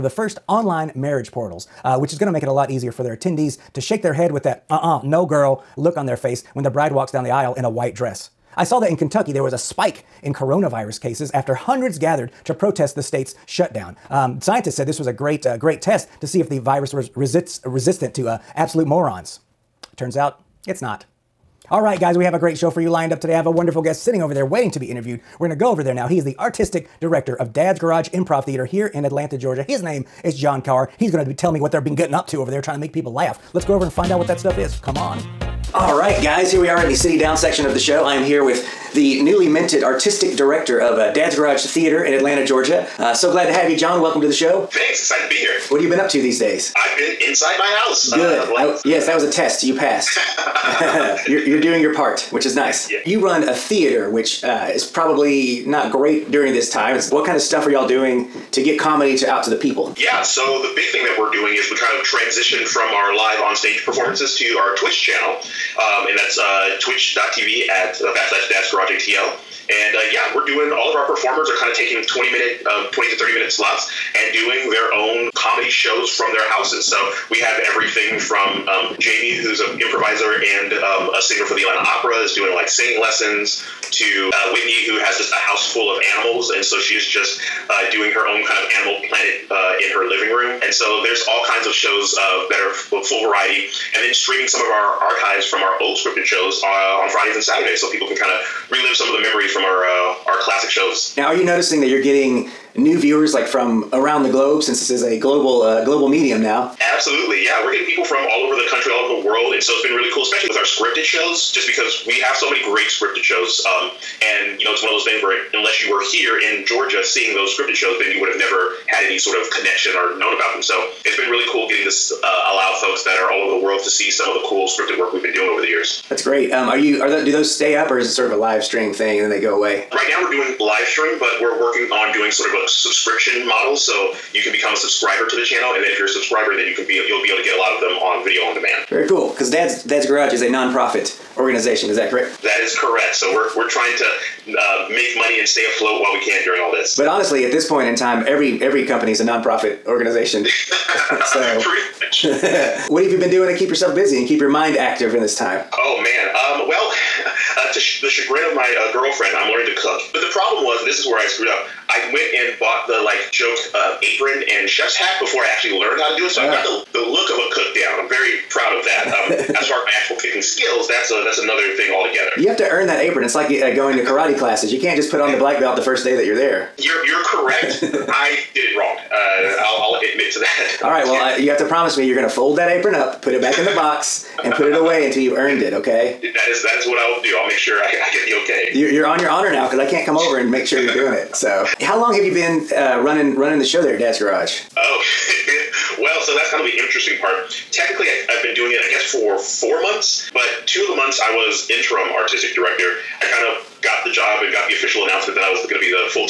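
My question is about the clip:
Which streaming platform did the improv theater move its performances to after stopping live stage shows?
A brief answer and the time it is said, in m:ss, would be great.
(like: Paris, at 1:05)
Twitch, at 1:04.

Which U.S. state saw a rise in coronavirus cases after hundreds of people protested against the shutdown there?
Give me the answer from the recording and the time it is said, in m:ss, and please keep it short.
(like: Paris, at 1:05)
Kentucky, at 0:08.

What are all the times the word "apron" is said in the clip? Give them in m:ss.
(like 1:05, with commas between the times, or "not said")
2:44, 2:52, 3:02.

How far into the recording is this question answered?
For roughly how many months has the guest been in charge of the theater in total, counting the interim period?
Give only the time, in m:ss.
3:19.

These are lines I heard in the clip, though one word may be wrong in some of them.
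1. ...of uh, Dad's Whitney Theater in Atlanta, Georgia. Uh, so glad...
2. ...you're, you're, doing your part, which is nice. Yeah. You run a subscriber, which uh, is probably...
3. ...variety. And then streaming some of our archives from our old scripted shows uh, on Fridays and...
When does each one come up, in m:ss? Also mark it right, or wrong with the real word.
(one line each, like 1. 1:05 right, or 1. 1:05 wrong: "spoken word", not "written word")
1. 0:40 wrong: "Garage", not "Whitney"
2. 0:51 wrong: "theater", not "subscriber"
3. 1:33 right.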